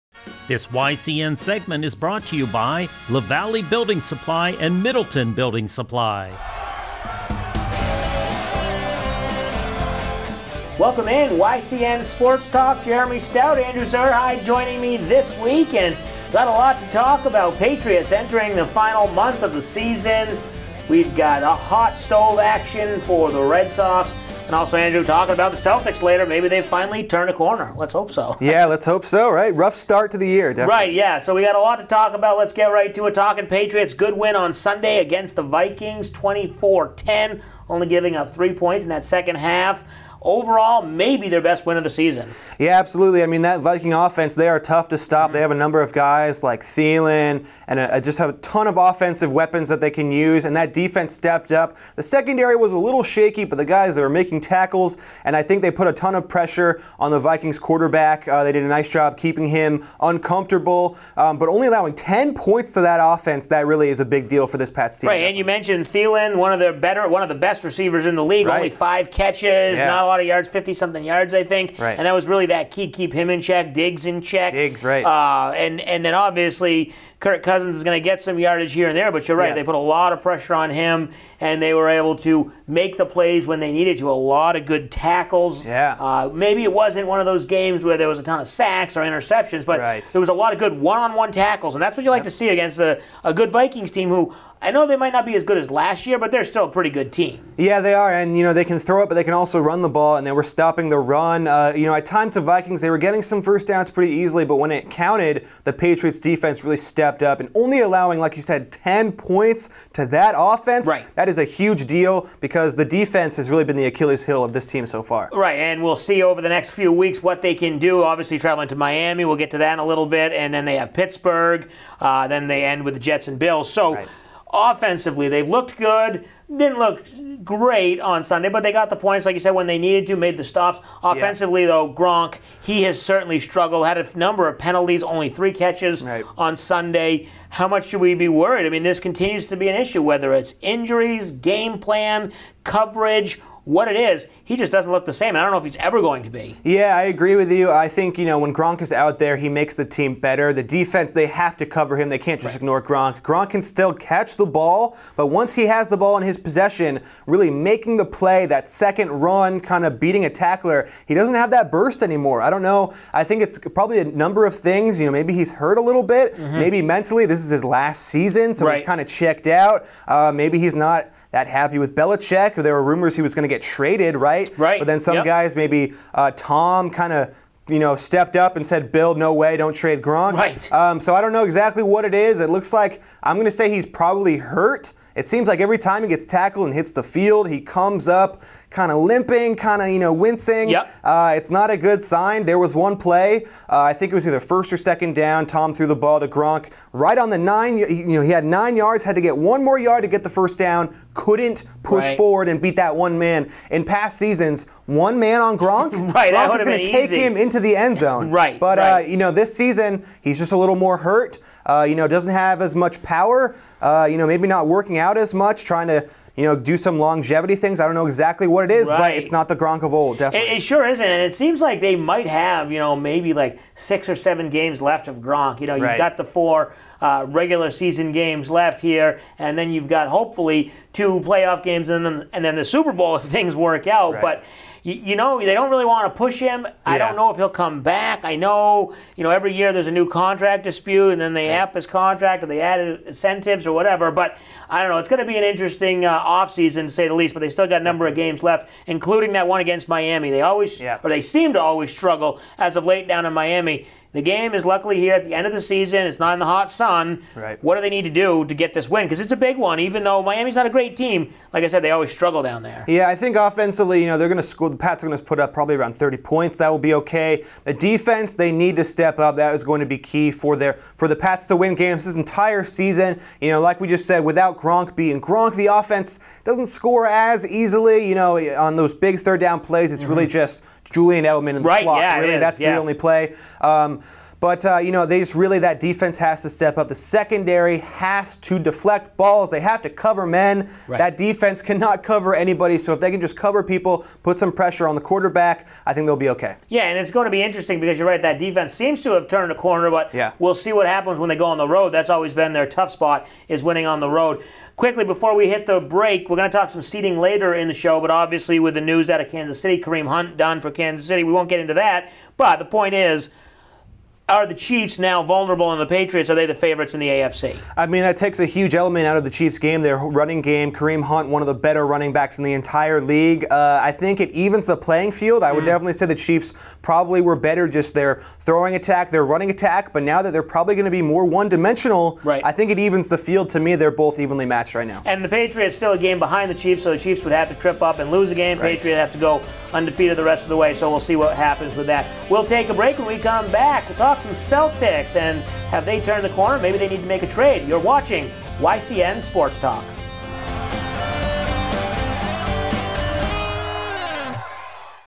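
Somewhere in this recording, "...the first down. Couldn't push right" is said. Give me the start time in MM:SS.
03:20.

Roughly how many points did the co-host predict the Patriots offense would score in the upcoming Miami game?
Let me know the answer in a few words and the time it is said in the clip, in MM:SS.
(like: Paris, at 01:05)
Around 30, at 04:25.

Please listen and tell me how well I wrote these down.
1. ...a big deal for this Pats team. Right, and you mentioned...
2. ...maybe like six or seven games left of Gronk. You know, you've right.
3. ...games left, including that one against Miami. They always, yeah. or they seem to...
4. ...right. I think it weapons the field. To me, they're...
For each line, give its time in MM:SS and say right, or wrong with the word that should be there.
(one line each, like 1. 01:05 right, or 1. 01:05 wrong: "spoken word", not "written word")
1. 01:03 right
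2. 03:42 right
3. 04:08 right
4. 05:32 wrong: "evens", not "weapons".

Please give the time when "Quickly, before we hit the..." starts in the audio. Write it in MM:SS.
05:04.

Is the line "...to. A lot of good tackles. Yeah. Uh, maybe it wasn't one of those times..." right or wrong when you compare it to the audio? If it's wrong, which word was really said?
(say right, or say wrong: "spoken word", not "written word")
wrong: "games", not "times".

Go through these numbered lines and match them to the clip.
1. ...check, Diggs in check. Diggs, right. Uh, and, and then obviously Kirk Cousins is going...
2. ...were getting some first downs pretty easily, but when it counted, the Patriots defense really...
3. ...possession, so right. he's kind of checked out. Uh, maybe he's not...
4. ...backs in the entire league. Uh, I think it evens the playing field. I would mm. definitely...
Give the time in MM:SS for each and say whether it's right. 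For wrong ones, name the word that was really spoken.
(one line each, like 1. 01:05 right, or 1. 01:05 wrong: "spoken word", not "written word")
1. 01:13 right
2. 01:42 right
3. 02:48 wrong: "season", not "possession"
4. 05:22 right.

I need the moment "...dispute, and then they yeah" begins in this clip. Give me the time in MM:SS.
04:00.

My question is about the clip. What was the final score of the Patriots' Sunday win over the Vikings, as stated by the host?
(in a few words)
24-10.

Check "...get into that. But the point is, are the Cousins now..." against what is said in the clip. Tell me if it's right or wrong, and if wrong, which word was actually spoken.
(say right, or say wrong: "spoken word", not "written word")
wrong: "Chiefs", not "Cousins".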